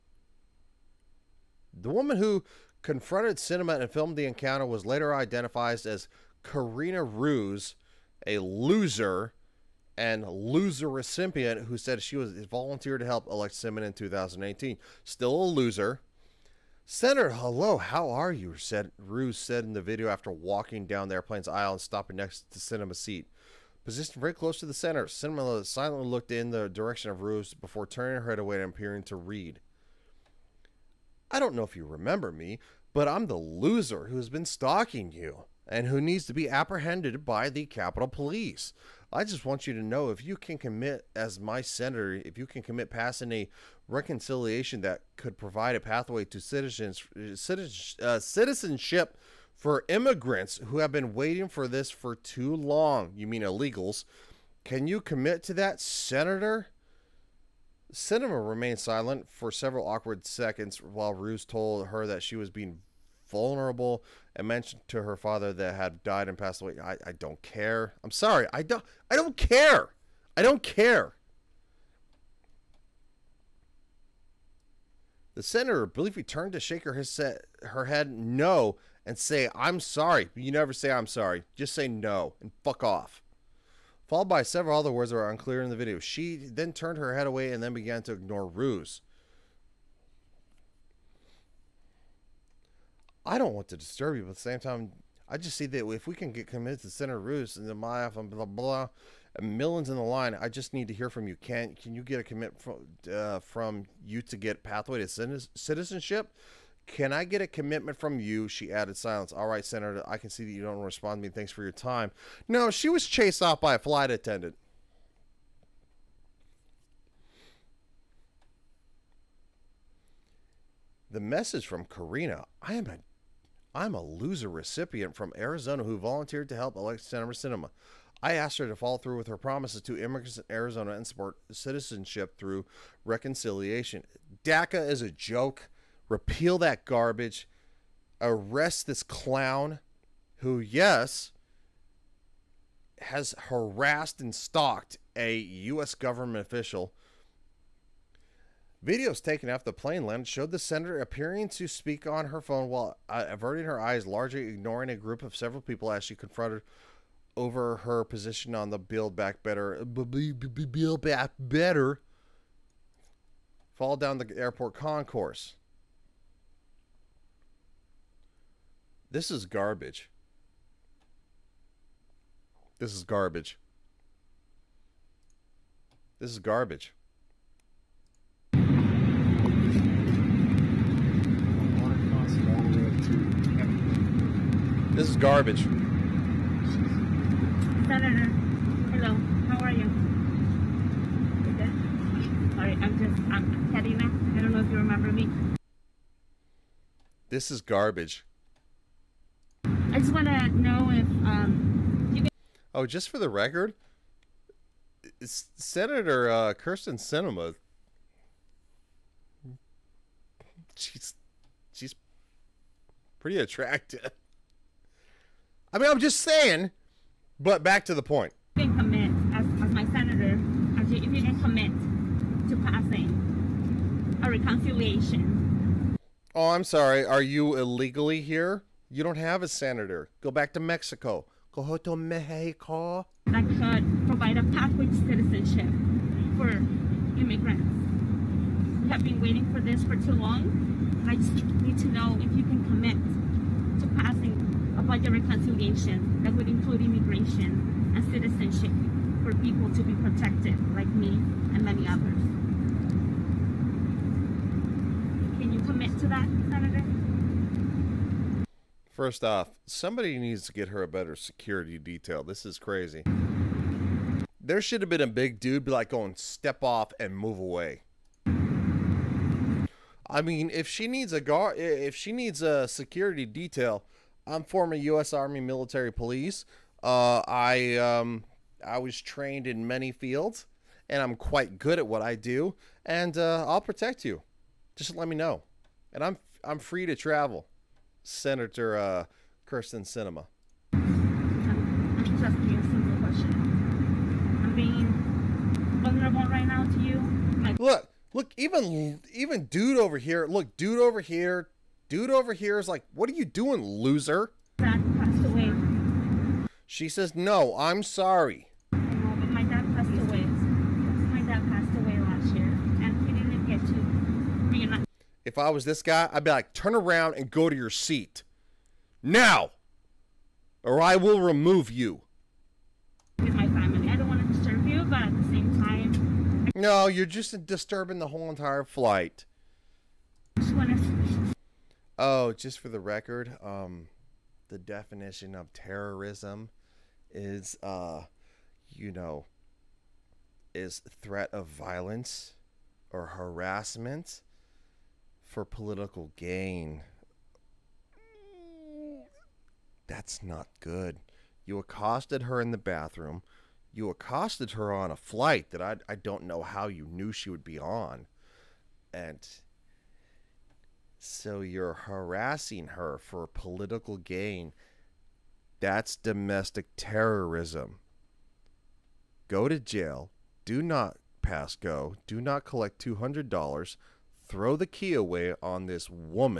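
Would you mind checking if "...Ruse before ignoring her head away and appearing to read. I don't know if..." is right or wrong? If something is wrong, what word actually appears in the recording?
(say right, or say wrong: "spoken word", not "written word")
wrong: "turning", not "ignoring".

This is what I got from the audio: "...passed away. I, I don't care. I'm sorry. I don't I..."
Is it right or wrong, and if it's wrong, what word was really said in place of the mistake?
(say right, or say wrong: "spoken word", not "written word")
right.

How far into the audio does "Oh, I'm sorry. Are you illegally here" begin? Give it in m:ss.
3:46.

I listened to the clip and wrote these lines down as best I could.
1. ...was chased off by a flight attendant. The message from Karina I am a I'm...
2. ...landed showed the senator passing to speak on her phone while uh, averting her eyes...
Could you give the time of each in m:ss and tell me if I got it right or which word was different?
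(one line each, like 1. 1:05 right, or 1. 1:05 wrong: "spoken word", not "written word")
1. 1:52 right
2. 2:30 wrong: "appearing", not "passing".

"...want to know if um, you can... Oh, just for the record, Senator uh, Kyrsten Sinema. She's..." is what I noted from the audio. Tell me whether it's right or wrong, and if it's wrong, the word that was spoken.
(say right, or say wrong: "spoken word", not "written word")
right.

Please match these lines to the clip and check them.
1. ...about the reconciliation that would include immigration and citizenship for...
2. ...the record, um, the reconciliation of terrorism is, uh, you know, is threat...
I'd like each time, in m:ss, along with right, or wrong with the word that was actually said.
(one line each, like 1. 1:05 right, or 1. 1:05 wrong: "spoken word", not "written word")
1. 4:04 right
2. 5:32 wrong: "definition", not "reconciliation".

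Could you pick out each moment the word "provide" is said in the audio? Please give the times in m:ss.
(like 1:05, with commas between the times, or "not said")
0:45, 3:54.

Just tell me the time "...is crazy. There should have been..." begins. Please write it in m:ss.
4:22.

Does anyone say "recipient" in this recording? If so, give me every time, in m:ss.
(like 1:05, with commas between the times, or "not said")
0:10, 2:04.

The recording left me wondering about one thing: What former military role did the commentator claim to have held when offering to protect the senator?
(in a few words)
Army military police.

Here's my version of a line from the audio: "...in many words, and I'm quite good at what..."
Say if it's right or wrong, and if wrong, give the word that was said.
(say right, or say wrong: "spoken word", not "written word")
wrong: "fields", not "words".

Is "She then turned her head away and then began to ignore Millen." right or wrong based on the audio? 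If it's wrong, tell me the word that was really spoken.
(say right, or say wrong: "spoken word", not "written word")
wrong: "Ruse", not "Millen".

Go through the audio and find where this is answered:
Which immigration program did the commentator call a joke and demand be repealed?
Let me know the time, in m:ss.
2:14.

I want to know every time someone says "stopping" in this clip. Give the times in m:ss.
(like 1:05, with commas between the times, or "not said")
0:21.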